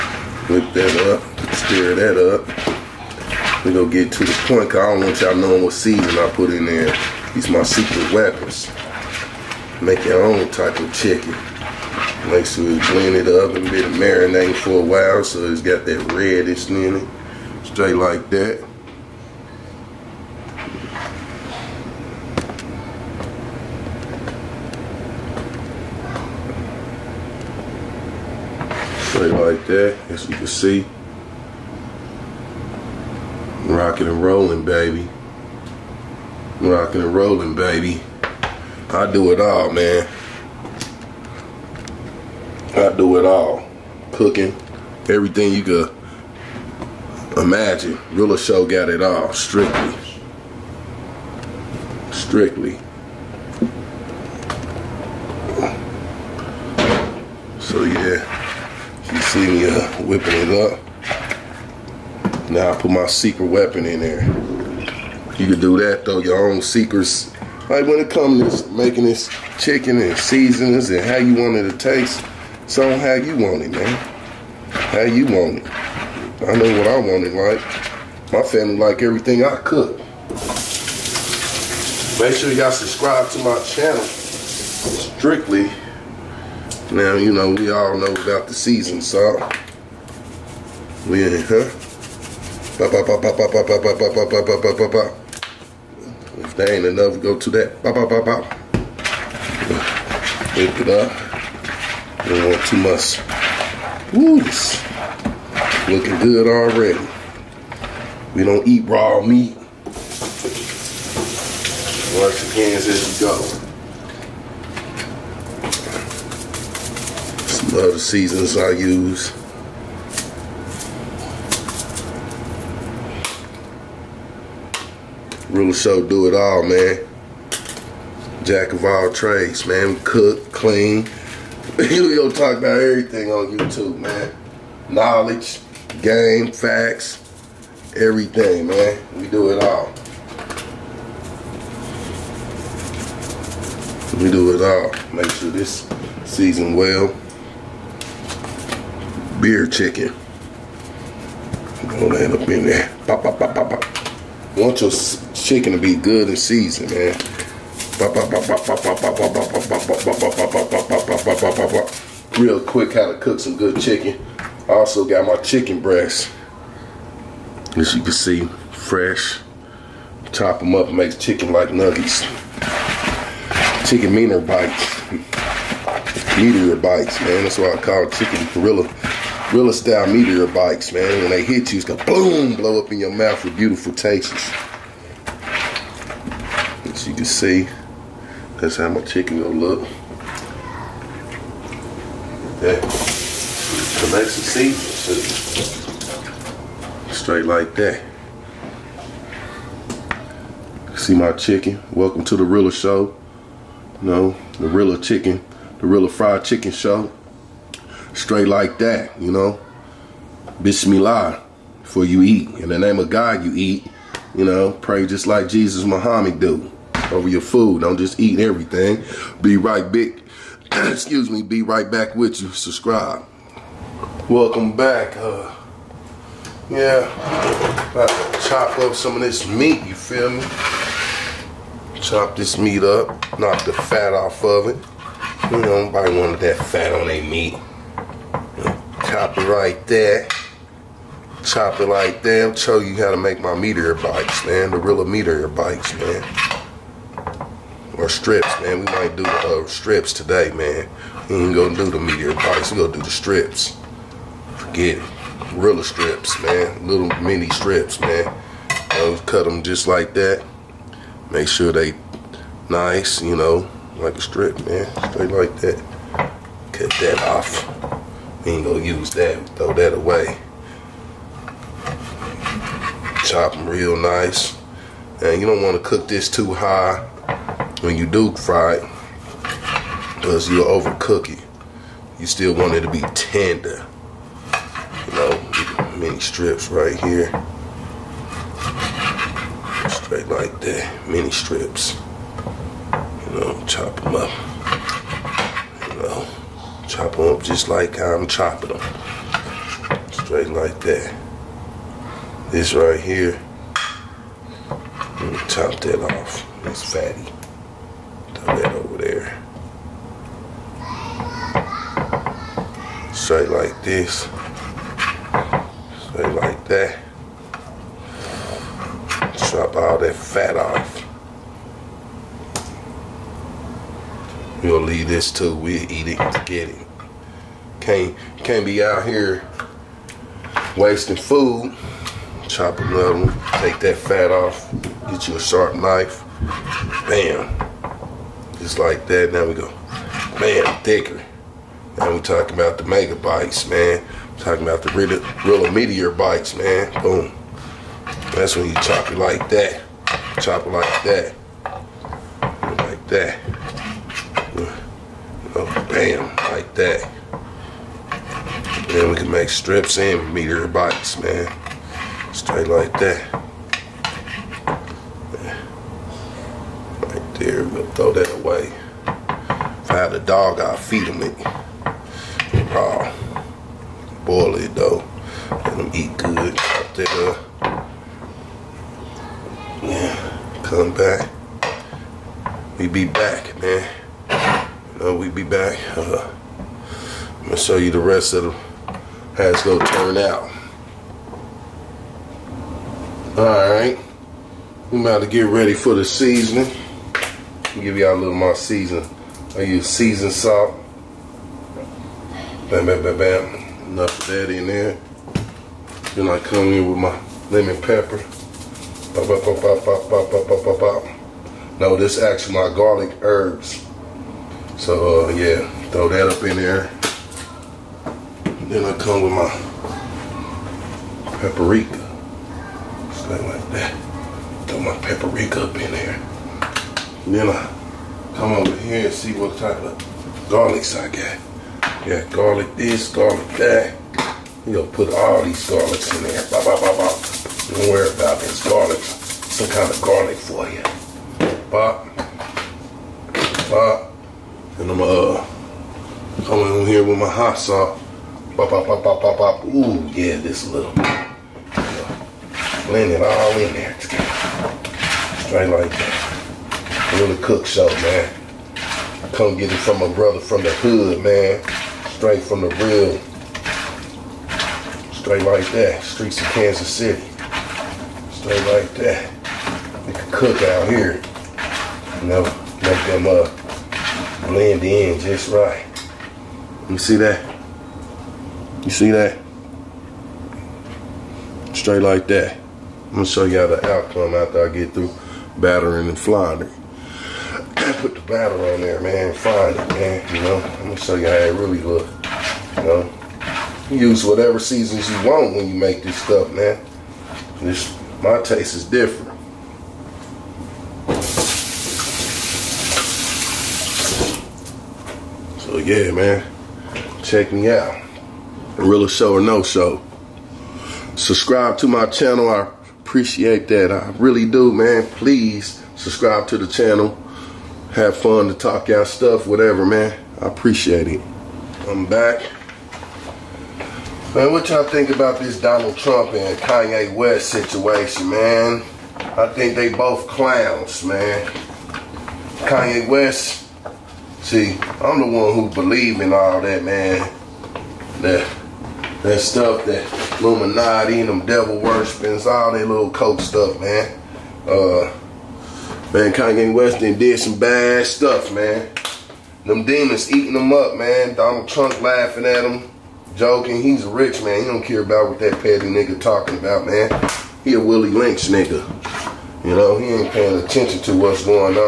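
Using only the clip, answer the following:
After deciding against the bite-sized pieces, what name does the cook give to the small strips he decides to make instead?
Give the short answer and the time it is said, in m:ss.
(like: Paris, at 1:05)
Gorilla strips, at 4:15.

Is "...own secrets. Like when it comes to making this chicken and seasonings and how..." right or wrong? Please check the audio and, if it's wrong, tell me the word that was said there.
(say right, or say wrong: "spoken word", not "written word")
right.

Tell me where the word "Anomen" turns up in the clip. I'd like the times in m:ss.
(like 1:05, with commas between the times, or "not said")
not said.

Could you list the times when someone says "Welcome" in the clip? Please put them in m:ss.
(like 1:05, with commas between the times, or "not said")
3:21, 3:44.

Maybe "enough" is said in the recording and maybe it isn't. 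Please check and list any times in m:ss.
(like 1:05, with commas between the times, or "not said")
1:36, 6:43.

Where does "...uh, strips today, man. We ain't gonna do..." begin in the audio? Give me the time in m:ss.
4:09.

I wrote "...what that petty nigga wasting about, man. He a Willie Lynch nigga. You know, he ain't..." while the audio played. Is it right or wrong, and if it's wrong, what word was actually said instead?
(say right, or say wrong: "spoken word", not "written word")
wrong: "talking", not "wasting".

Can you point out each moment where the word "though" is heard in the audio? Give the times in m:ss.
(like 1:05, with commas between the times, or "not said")
1:06, 6:14.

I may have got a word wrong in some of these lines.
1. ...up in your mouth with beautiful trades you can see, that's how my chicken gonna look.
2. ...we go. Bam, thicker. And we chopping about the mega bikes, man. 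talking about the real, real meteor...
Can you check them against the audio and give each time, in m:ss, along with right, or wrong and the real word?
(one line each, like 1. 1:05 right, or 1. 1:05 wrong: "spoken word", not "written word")
1. 3:02 wrong: "tastes", not "trades"
2. 5:39 wrong: "talking", not "chopping".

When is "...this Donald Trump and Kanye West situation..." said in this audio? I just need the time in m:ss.
8:45.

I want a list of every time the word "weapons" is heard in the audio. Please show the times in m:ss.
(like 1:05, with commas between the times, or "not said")
0:08, 1:03.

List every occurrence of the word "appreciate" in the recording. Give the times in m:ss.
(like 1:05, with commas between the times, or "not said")
8:33, 8:40.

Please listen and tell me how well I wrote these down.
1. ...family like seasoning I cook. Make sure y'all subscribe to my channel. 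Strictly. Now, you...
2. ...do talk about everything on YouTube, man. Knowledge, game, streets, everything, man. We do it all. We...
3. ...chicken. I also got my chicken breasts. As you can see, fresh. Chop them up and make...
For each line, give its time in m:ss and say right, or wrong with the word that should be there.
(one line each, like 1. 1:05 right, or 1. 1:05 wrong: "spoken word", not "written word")
1. 1:18 wrong: "everything", not "seasoning"
2. 2:11 wrong: "facts", not "streets"
3. 2:43 right.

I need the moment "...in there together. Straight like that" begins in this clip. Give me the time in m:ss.
7:33.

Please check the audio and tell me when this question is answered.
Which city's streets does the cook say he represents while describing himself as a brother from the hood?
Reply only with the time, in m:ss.
7:46.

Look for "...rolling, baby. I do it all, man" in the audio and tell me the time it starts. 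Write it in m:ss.
0:37.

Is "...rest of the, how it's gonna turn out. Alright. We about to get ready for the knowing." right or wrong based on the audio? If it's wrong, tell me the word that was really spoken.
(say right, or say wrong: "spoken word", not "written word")
wrong: "seasoning", not "knowing".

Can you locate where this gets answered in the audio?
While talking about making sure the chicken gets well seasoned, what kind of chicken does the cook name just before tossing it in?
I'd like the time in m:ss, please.
2:29.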